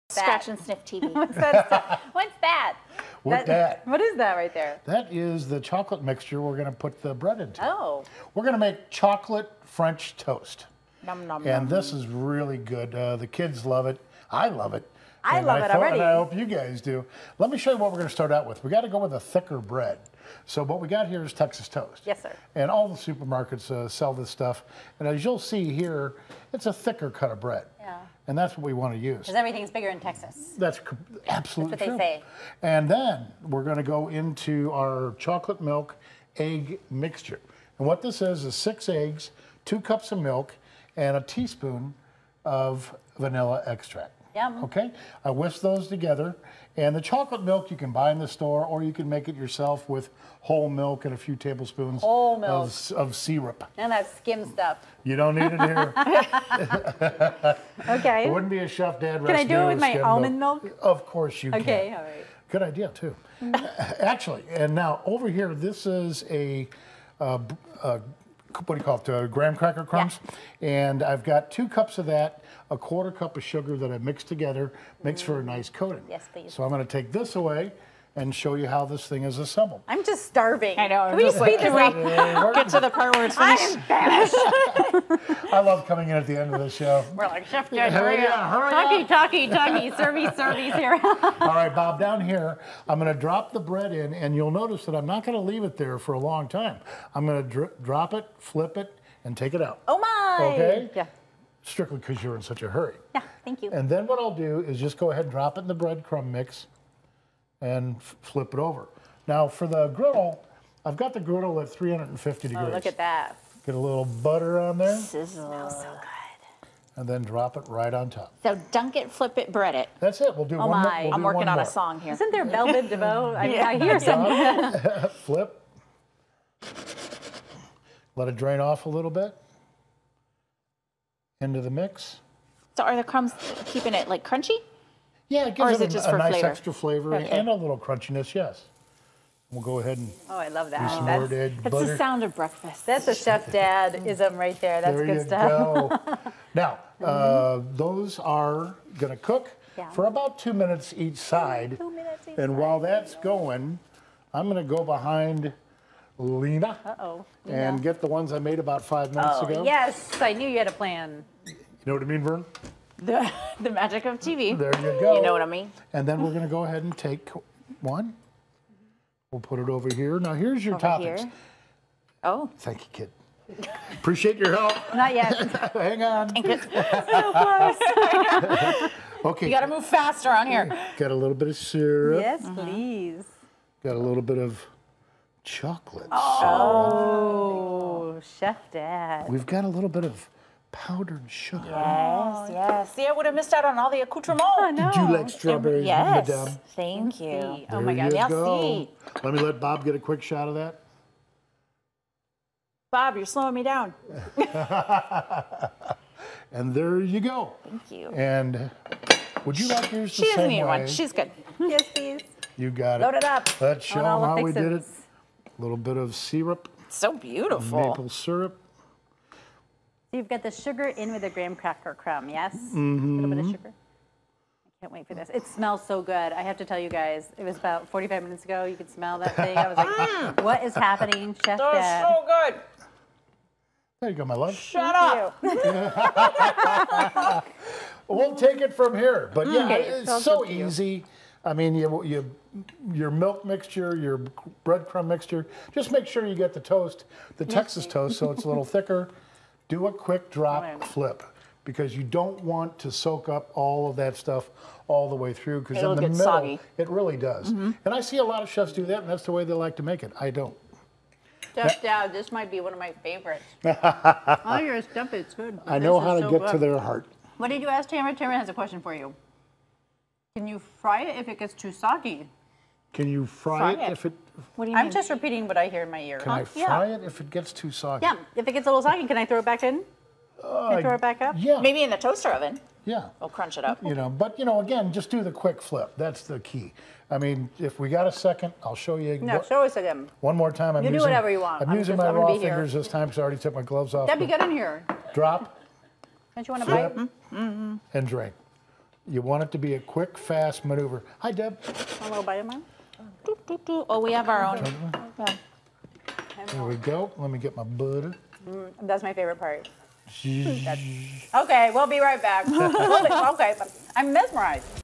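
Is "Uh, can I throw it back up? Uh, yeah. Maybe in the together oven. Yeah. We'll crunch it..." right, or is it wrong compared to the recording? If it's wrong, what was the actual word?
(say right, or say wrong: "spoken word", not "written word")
wrong: "toaster", not "together".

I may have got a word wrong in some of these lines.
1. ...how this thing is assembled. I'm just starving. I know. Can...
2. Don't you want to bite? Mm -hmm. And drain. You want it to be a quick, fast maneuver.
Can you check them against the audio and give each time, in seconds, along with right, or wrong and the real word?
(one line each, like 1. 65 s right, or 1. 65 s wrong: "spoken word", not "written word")
1. 78 s right
2. 296 s right.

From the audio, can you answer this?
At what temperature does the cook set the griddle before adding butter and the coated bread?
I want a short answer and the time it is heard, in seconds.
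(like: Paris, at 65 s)
350 degrees, at 111 s.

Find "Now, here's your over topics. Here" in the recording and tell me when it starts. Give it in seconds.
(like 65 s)
170 s.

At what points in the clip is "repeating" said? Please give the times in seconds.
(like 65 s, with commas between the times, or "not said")
275 s.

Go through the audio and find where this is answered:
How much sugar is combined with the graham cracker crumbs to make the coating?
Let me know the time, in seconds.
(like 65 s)
72 s.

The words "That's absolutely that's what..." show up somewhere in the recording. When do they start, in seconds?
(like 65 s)
30 s.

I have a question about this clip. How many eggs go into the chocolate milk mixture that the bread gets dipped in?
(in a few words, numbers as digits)
6.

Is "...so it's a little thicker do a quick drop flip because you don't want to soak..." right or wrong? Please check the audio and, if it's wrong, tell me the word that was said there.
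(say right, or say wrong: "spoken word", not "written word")
right.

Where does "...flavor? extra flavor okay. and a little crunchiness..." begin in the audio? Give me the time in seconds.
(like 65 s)
136 s.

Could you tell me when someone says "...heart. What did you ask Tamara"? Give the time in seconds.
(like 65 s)
266 s.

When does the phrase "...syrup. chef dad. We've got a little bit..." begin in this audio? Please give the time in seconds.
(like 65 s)
187 s.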